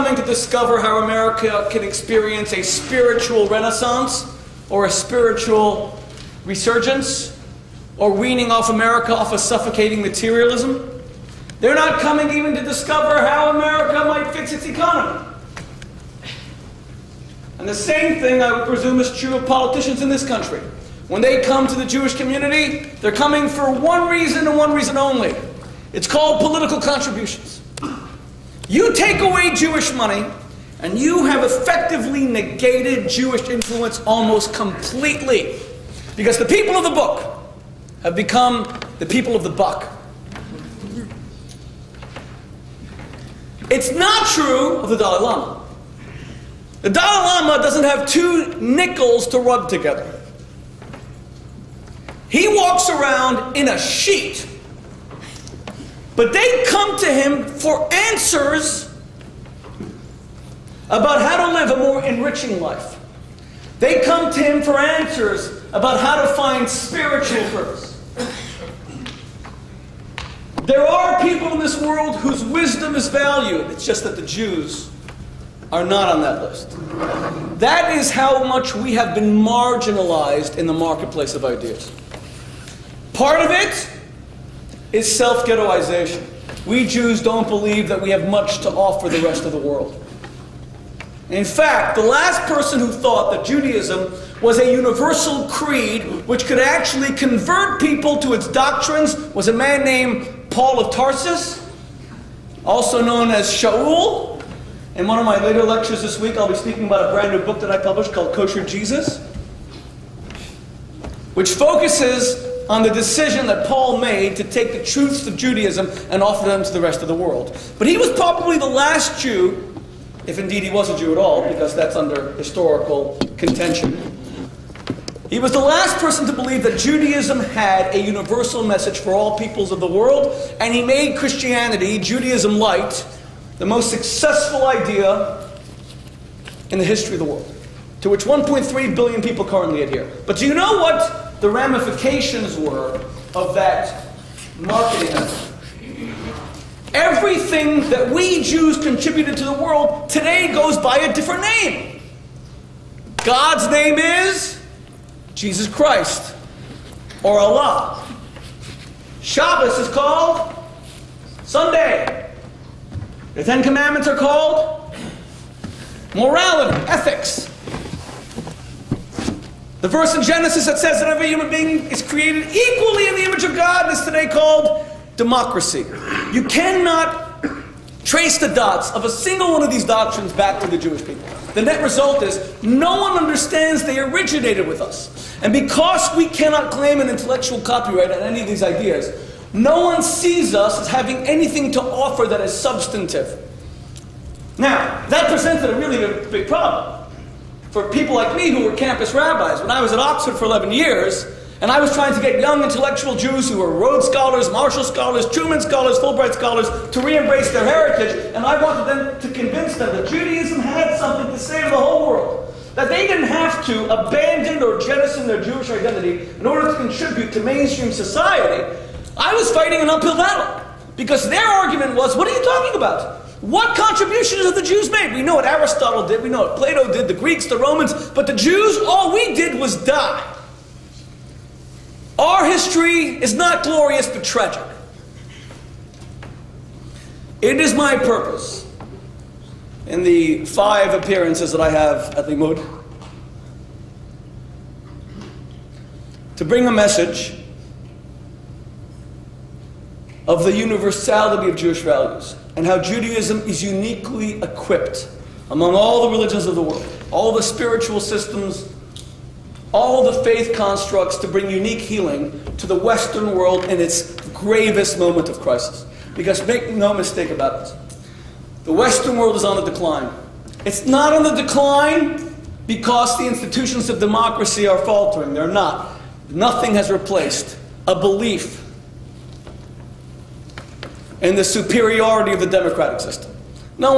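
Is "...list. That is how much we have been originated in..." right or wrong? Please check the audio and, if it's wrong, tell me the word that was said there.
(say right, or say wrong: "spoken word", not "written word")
wrong: "marginalized", not "originated".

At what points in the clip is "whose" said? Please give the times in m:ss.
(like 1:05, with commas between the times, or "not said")
1:12.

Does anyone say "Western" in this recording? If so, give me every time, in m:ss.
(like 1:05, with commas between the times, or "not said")
4:22, 4:28.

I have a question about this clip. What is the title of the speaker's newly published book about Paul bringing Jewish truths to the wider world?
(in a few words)
Kosher Jesus.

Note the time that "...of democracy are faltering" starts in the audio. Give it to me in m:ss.
4:33.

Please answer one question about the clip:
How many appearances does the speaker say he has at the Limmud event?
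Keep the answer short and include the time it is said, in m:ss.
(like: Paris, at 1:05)
5, at 4:00.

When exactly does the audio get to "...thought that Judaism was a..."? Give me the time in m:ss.
1:32.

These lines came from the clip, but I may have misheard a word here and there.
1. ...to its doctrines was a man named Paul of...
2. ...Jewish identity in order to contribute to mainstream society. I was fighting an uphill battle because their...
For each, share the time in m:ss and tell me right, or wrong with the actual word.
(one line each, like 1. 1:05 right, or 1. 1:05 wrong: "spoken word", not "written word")
1. 1:38 right
2. 3:35 right.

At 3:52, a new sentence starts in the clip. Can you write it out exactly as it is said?
Our history is not glorious but tragic.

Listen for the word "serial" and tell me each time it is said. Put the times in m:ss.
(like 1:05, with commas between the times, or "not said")
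not said.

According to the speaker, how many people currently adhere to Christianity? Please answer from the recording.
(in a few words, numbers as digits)
1.3 billion.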